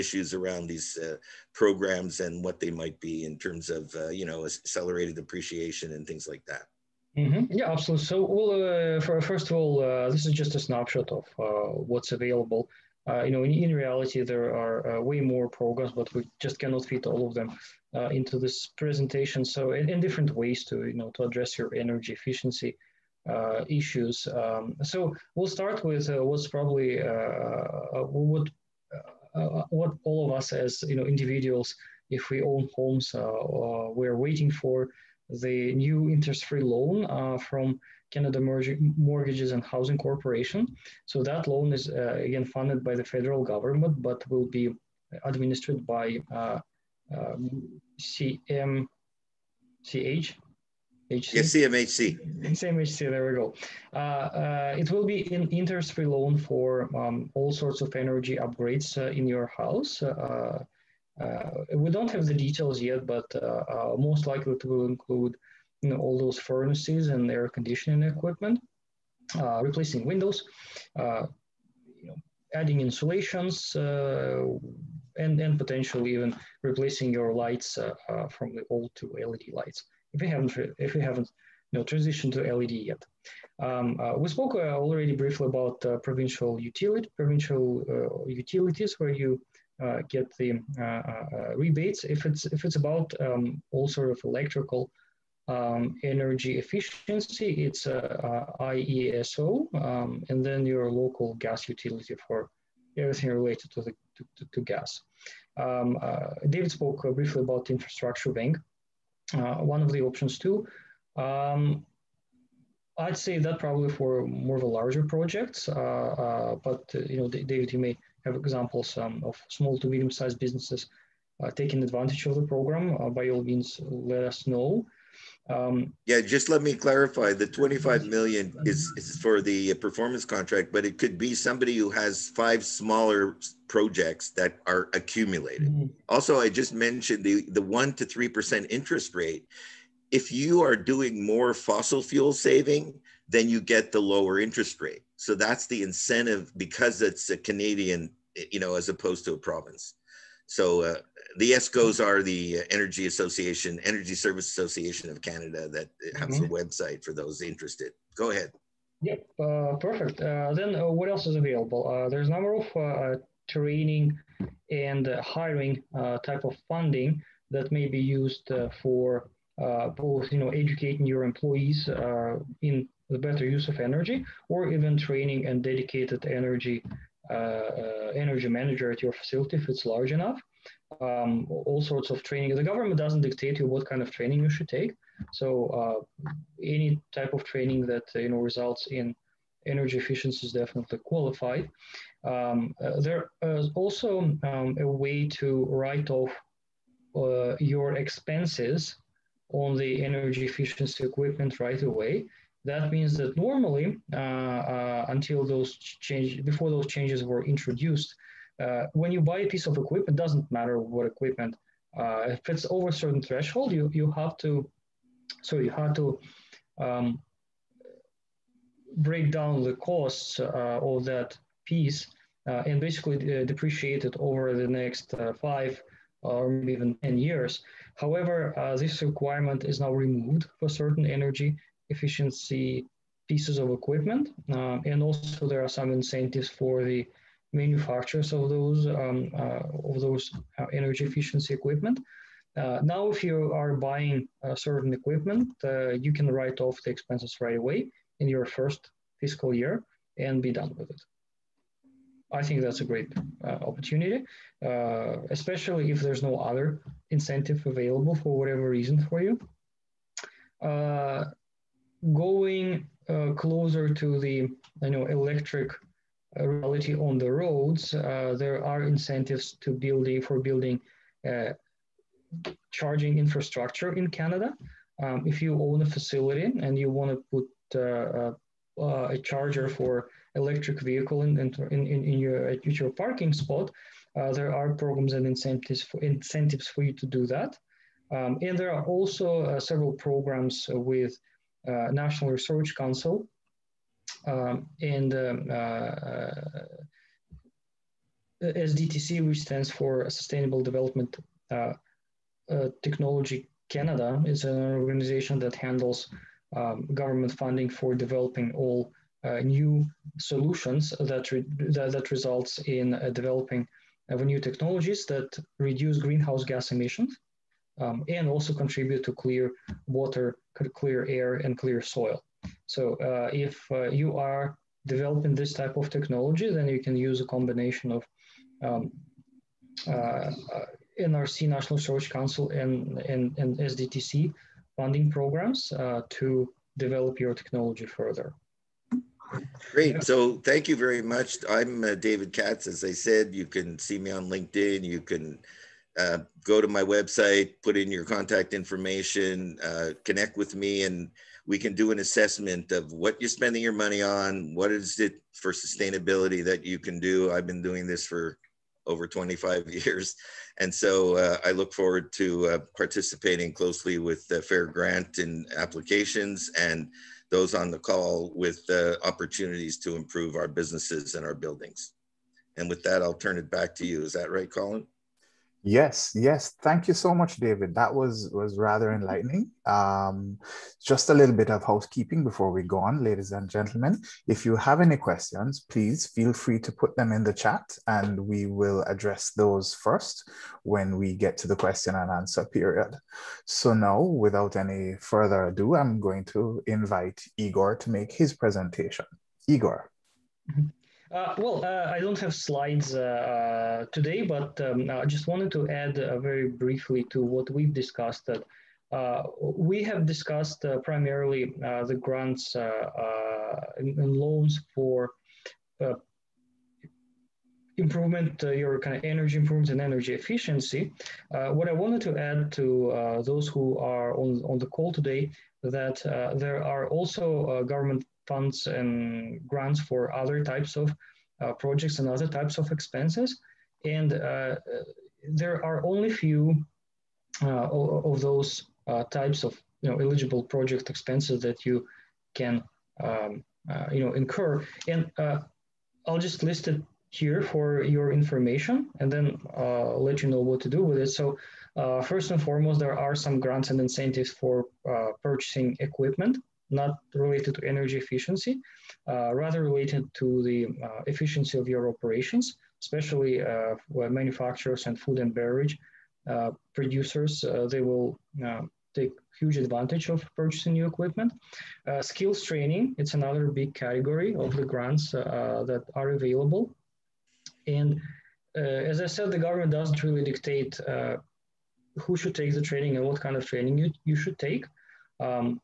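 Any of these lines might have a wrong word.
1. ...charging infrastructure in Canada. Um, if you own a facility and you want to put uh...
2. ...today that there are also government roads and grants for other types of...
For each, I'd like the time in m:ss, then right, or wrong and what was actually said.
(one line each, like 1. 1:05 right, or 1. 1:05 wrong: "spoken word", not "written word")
1. 4:32 right
2. 7:04 wrong: "funds", not "roads".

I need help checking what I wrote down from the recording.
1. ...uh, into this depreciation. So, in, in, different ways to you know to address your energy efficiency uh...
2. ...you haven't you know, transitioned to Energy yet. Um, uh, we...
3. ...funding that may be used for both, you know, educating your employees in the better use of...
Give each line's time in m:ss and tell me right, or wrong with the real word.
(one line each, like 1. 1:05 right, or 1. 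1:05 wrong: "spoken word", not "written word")
1. 0:17 wrong: "presentation", not "depreciation"
2. 1:20 wrong: "LED", not "Energy"
3. 2:46 right.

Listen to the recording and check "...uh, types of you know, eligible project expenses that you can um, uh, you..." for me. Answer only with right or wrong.
right.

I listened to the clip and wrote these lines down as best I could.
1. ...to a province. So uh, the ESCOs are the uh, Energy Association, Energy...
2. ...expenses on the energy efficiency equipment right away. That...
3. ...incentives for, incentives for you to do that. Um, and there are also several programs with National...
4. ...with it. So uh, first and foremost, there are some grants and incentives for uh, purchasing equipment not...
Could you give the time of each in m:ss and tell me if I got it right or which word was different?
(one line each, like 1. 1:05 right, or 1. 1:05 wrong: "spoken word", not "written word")
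1. 2:29 right
2. 3:17 right
3. 4:45 right
4. 7:30 right.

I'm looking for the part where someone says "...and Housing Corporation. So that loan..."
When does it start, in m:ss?
0:39.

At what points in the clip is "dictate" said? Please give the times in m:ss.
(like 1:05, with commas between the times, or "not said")
3:03, 8:00.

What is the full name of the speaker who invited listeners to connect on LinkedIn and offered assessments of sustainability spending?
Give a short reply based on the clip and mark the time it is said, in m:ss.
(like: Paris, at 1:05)
David Katz, at 5:41.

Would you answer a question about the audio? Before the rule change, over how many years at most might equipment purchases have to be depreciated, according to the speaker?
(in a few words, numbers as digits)
10.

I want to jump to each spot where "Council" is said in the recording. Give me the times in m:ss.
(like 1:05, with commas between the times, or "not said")
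4:52, 5:32.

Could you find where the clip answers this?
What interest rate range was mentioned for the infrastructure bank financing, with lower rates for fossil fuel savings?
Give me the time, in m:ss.
2:17.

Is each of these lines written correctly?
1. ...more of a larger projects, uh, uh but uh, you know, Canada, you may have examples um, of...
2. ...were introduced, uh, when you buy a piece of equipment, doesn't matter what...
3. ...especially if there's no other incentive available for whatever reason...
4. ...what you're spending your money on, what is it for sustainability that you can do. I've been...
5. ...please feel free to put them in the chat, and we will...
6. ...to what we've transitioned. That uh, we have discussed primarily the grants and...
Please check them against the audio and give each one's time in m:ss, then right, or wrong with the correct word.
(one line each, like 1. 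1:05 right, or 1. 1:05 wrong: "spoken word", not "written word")
1. 1:54 wrong: "David", not "Canada"
2. 3:27 right
3. 4:15 right
4. 5:52 right
5. 6:25 right
6. 6:47 wrong: "discussed", not "transitioned".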